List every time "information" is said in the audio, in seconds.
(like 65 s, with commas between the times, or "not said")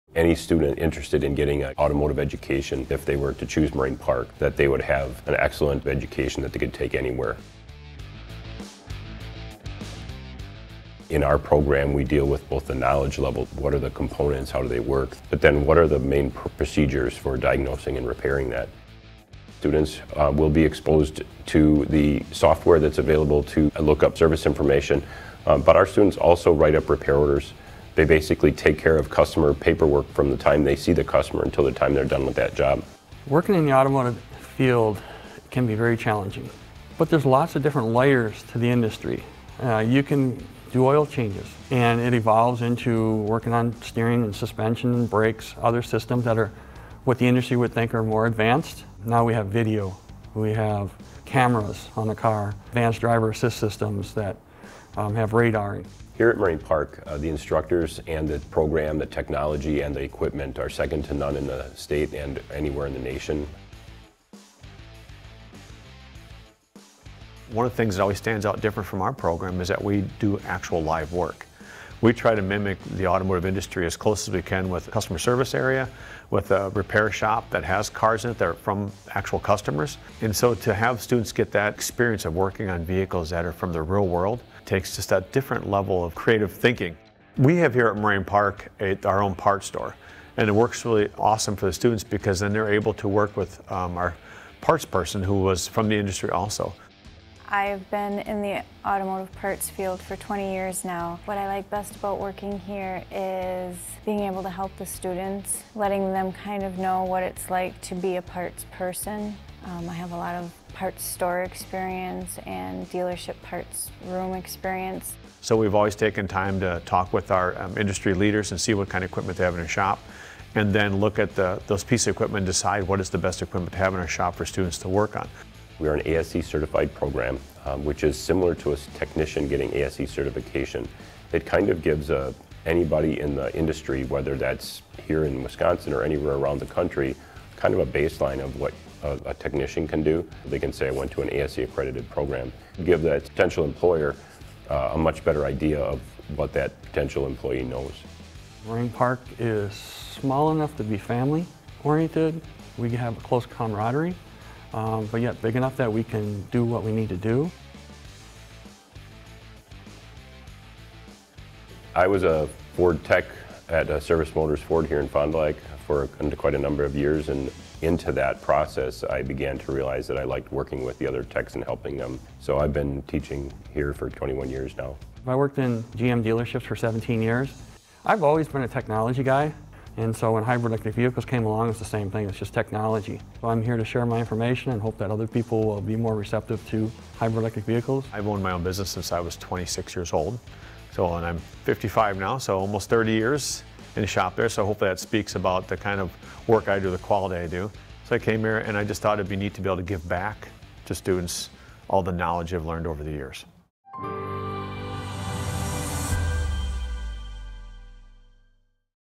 24 s, 184 s.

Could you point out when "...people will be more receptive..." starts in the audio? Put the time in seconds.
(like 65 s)
185 s.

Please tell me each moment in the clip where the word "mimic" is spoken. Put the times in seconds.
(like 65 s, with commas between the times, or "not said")
72 s.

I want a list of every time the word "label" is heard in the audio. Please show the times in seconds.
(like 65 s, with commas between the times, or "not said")
not said.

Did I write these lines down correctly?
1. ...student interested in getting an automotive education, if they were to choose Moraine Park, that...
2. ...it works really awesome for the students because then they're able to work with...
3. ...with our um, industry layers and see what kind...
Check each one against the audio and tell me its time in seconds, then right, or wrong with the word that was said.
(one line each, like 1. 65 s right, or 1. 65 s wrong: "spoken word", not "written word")
1. 0 s right
2. 90 s right
3. 117 s wrong: "leaders", not "layers".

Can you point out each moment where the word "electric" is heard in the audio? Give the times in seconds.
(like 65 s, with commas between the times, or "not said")
180 s, 187 s.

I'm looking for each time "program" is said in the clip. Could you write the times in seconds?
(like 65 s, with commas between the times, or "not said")
11 s, 58 s, 69 s, 126 s, 142 s.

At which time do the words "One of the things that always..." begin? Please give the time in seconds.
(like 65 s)
67 s.